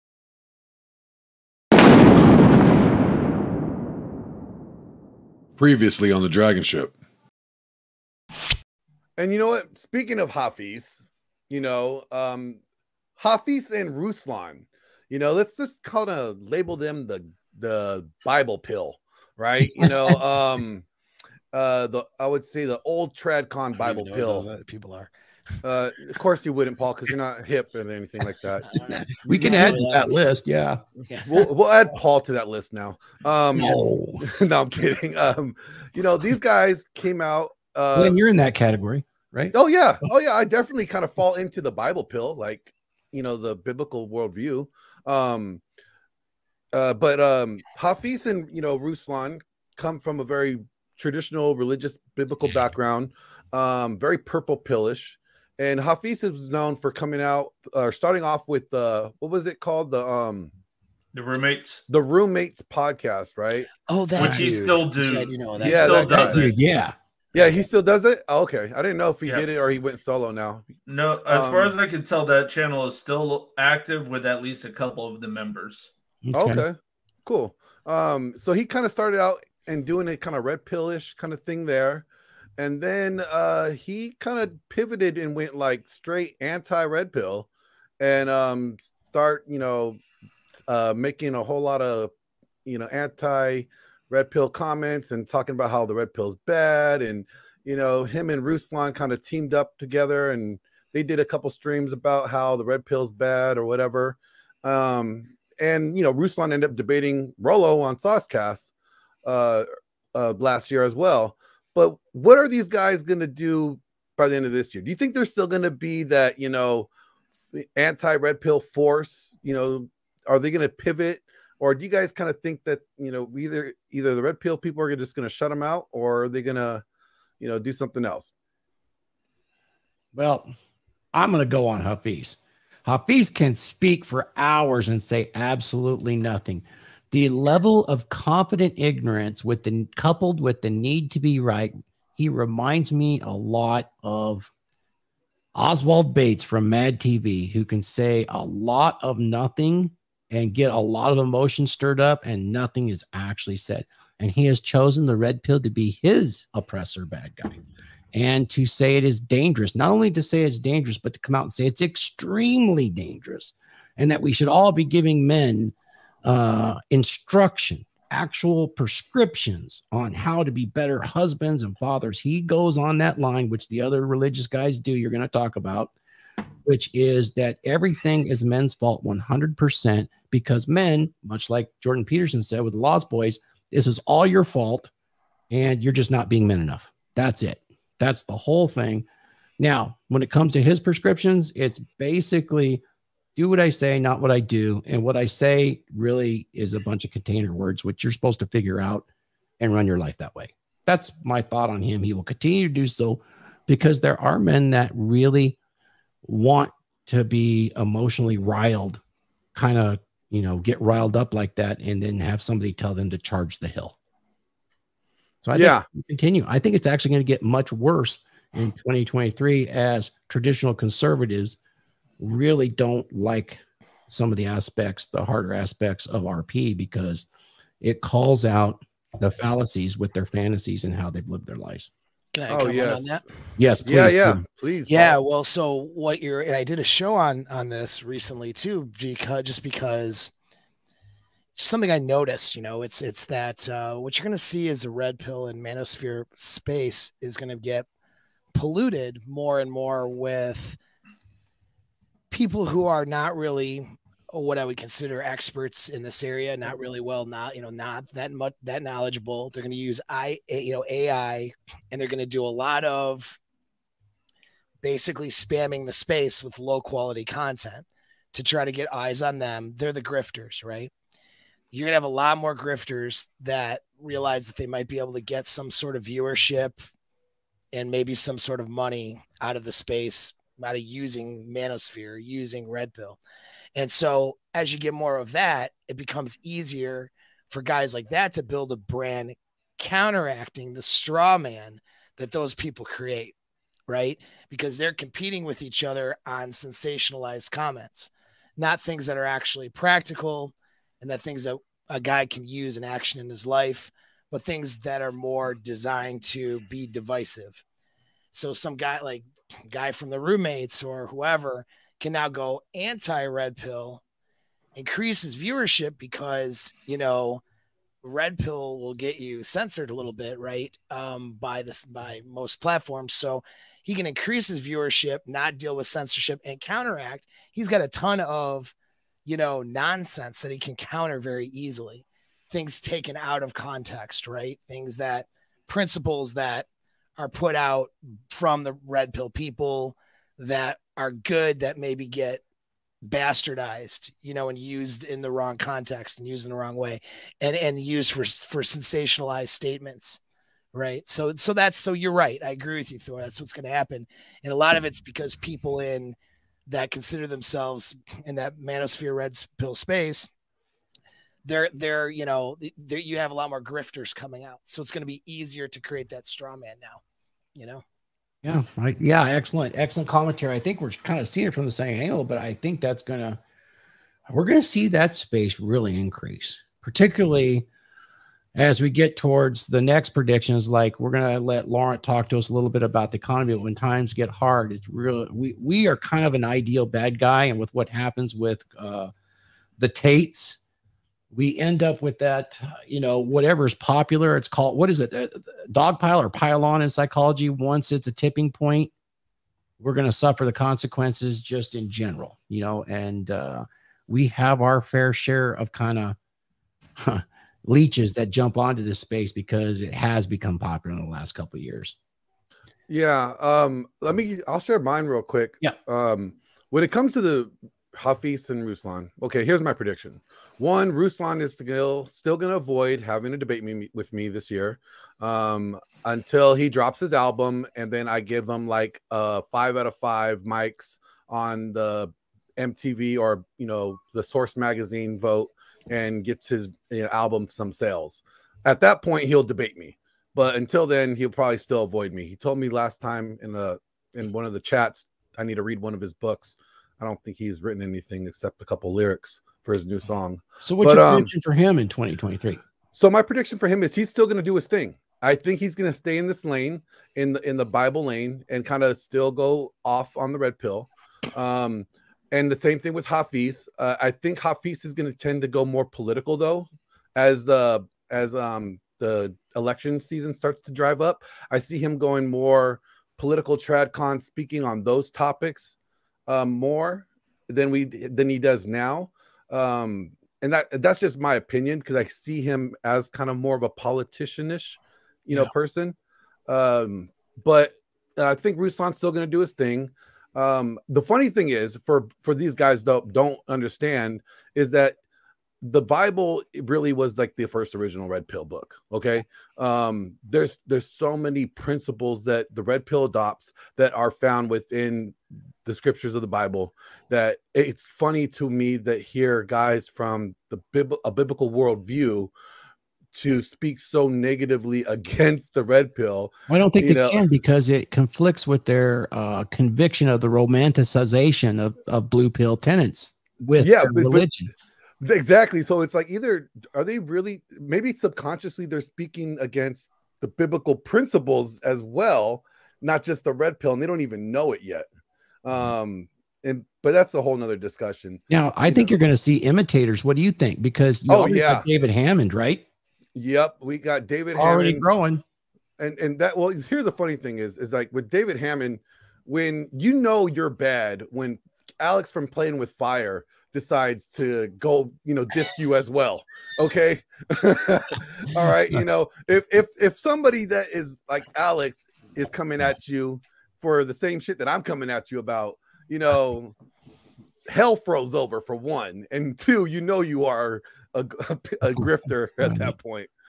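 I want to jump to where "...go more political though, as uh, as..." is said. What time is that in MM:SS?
07:45.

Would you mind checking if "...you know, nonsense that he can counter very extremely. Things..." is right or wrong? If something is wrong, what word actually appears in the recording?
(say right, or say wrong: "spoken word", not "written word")
wrong: "easily", not "extremely".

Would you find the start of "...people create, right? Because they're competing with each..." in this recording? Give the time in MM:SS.
04:52.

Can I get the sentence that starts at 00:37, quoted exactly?
Uh, you're in that category, right?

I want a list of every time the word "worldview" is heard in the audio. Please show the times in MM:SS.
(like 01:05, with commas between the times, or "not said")
00:44, 08:31.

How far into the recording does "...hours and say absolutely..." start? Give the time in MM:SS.
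02:14.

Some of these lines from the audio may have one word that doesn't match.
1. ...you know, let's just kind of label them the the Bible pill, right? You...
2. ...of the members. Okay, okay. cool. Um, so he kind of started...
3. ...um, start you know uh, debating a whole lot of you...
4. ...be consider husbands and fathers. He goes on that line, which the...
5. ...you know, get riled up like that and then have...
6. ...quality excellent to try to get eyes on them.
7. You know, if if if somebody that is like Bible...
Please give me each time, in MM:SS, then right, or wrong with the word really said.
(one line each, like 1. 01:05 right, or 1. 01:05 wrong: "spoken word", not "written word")
1. 00:15 right
2. 01:15 right
3. 01:28 wrong: "making", not "debating"
4. 02:50 wrong: "better", not "consider"
5. 03:30 right
6. 04:26 wrong: "content", not "excellent"
7. 09:18 wrong: "Alex", not "Bible".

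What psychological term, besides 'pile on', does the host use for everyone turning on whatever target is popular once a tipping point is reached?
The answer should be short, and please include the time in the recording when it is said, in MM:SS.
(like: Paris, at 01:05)
Dog pile, at 06:35.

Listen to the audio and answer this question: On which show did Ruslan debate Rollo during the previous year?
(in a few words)
Saucecast.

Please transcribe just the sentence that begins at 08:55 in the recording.
Um, and but that's a whole nother discussion.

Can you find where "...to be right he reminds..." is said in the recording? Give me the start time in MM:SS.
02:21.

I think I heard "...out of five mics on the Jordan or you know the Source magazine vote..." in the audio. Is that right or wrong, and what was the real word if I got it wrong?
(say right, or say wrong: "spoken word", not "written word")
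wrong: "MTV", not "Jordan".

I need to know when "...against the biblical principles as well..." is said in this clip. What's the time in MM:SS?
08:49.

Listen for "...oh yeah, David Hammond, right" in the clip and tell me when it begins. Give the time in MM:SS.
09:01.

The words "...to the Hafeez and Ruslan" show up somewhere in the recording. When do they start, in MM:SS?
06:57.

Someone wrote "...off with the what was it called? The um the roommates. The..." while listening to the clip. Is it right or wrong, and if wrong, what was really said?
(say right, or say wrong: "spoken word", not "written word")
right.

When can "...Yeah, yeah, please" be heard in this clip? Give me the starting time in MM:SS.
03:53.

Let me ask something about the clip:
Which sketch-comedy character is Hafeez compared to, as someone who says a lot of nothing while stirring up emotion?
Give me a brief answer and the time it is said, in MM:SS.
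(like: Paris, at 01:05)
Oswald Bates, at 02:25.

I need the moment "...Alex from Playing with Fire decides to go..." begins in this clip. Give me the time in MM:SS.
09:11.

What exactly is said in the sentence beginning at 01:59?
You know, are they going to pivot?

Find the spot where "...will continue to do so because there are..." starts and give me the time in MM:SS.
03:22.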